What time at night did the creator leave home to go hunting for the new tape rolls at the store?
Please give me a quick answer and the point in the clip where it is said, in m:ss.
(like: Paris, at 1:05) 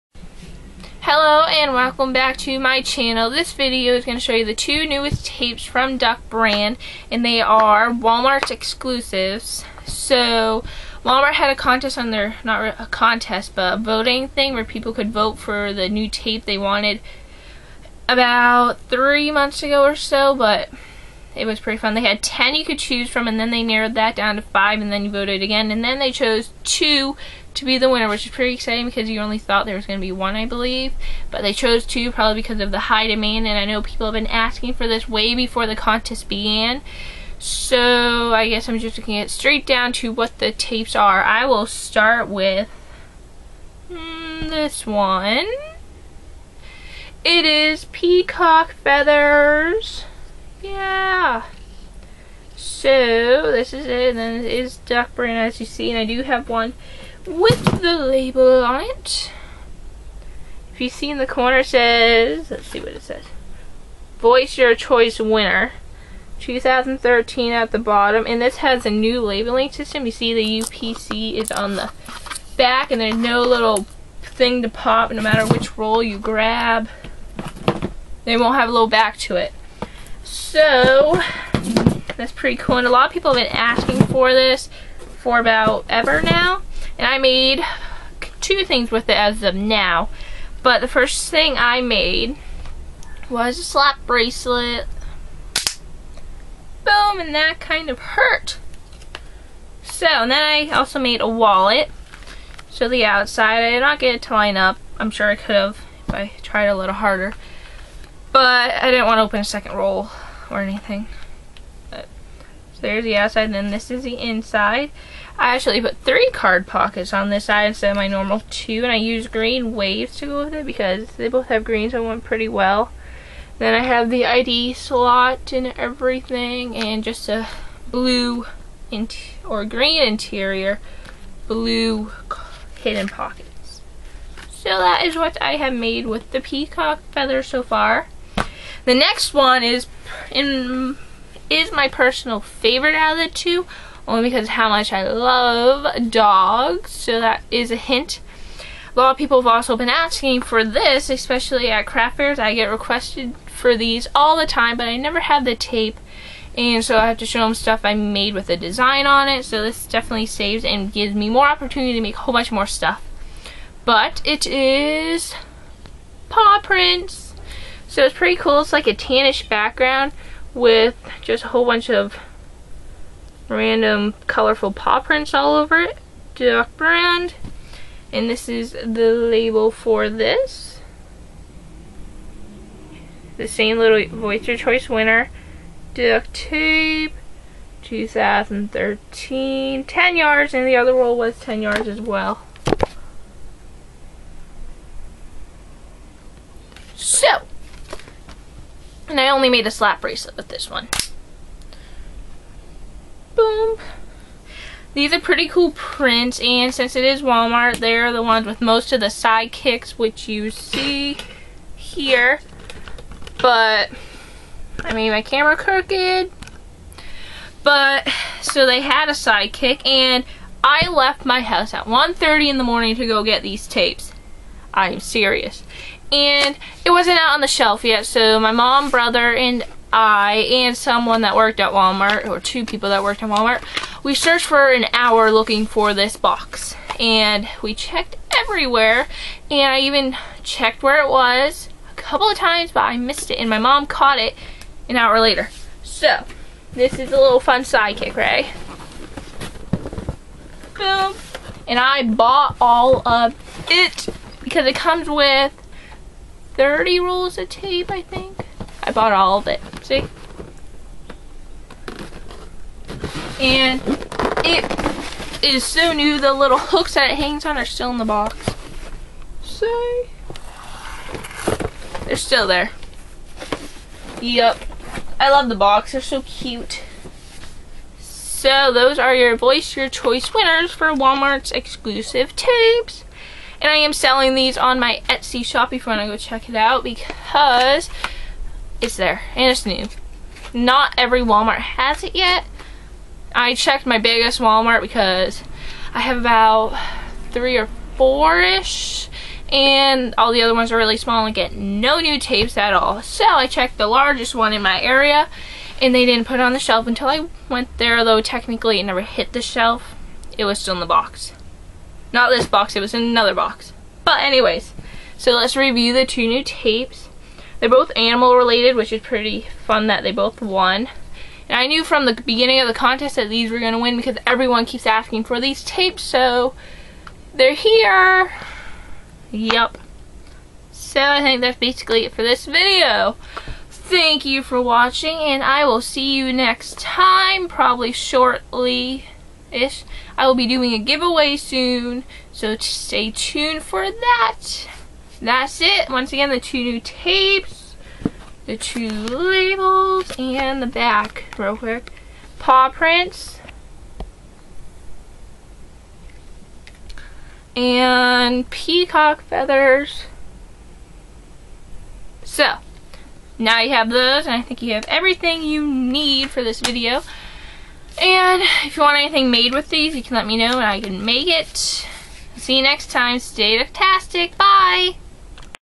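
1:30 a.m., at 3:41.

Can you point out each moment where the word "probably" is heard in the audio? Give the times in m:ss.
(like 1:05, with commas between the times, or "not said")
0:32, 5:37.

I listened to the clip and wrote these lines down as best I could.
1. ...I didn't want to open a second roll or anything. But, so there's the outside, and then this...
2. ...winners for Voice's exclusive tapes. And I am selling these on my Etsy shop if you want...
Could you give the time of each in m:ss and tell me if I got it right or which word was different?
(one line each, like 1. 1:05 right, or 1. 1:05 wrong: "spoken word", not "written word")
1. 1:48 right
2. 4:40 wrong: "Walmart", not "Voice".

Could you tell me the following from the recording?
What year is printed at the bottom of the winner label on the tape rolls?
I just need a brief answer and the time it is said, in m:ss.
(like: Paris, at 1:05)
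2013, at 1:06.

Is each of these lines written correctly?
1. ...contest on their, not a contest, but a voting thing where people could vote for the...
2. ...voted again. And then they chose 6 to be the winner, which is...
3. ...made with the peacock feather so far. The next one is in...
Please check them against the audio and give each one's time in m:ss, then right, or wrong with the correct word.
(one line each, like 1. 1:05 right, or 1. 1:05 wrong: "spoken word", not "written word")
1. 0:11 right
2. 0:25 wrong: "2", not "6"
3. 2:15 right.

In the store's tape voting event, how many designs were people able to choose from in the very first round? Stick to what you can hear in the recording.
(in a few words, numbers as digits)
10.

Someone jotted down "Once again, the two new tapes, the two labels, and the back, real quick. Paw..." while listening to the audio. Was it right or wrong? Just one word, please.
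right.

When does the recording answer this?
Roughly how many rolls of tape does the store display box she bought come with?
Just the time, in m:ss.
4:14.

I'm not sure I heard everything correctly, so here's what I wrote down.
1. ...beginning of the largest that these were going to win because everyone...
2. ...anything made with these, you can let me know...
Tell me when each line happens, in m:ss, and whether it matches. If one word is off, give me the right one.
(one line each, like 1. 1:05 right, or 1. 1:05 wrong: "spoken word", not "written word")
1. 5:22 wrong: "contest", not "largest"
2. 6:08 right.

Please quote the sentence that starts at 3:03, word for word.
The same little your Choice winner.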